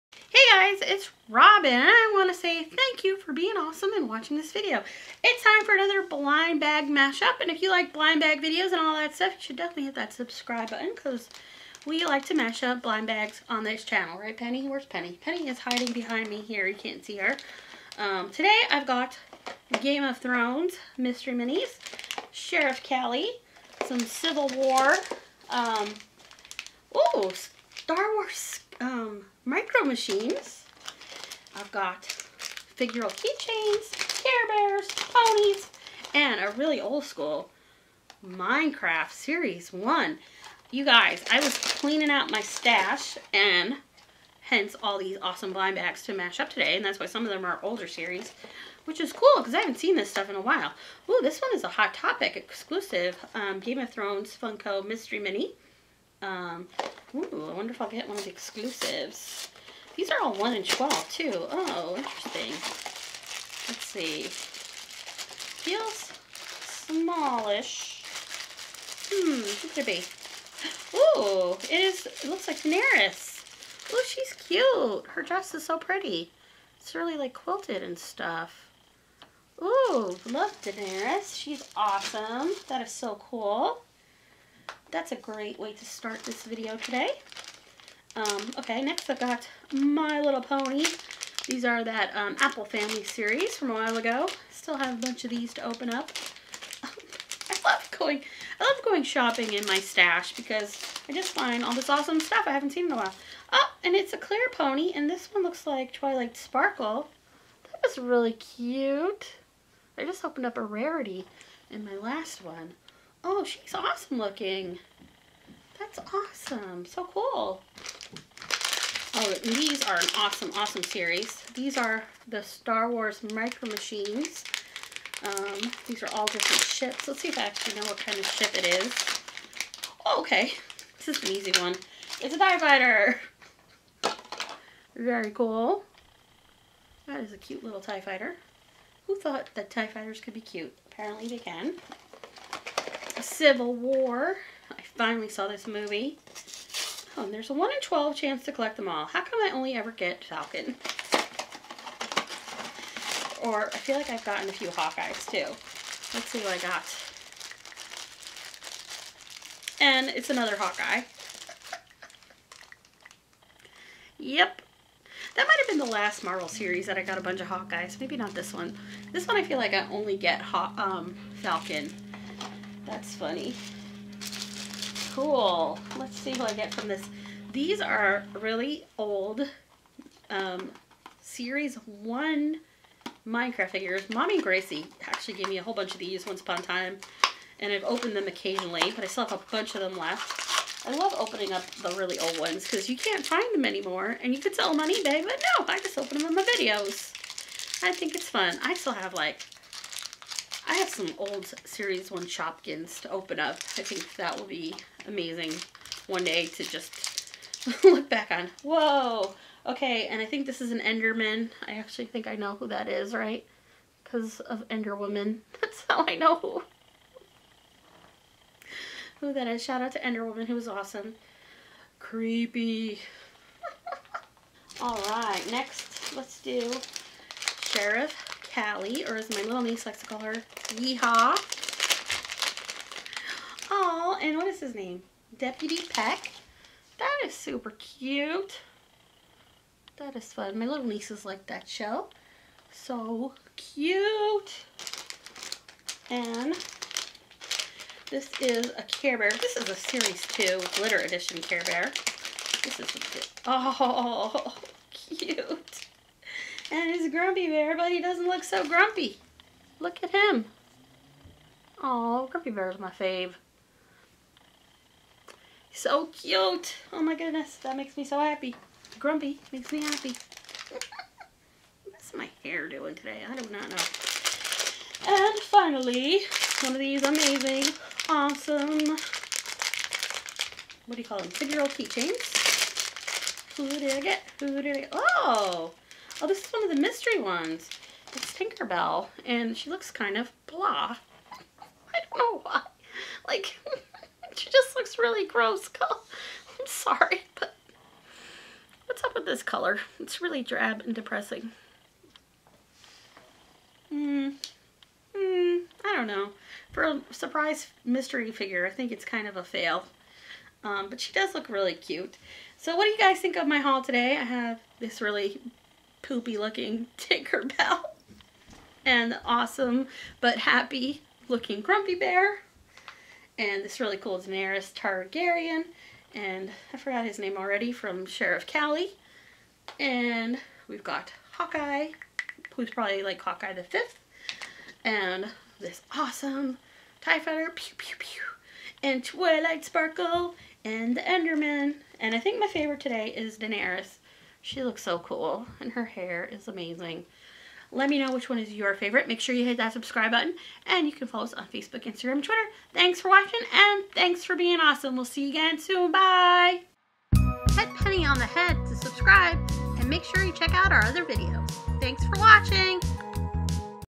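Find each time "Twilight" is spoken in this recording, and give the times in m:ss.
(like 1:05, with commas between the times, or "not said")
1:45, 5:39.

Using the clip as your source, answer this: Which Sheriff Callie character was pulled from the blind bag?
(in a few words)
Deputy Peck.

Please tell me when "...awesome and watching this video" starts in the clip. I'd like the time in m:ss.
0:03.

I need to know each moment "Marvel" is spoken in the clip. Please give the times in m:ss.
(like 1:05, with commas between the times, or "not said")
2:46.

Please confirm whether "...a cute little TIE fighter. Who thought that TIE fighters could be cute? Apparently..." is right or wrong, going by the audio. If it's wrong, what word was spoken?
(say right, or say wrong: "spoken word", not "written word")
right.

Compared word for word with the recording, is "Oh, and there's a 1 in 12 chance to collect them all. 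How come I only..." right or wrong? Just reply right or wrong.
right.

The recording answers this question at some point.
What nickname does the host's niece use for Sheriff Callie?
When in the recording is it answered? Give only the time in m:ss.
3:50.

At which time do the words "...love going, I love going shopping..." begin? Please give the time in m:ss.
1:37.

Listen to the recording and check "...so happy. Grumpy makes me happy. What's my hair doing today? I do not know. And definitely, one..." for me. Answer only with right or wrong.
wrong.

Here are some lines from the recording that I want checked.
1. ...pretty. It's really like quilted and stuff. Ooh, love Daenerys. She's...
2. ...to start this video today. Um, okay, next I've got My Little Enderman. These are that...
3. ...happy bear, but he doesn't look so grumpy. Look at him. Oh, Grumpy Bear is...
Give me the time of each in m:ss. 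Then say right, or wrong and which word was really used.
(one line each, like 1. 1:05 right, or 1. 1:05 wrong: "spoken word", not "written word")
1. 1:15 right
2. 1:25 wrong: "Pony", not "Enderman"
3. 4:17 wrong: "grumpy", not "happy".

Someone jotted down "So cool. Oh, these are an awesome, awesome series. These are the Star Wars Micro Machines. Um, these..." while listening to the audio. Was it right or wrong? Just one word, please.
right.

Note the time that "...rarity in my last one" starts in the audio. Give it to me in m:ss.
1:50.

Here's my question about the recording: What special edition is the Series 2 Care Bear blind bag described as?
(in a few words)
Glitter Edition.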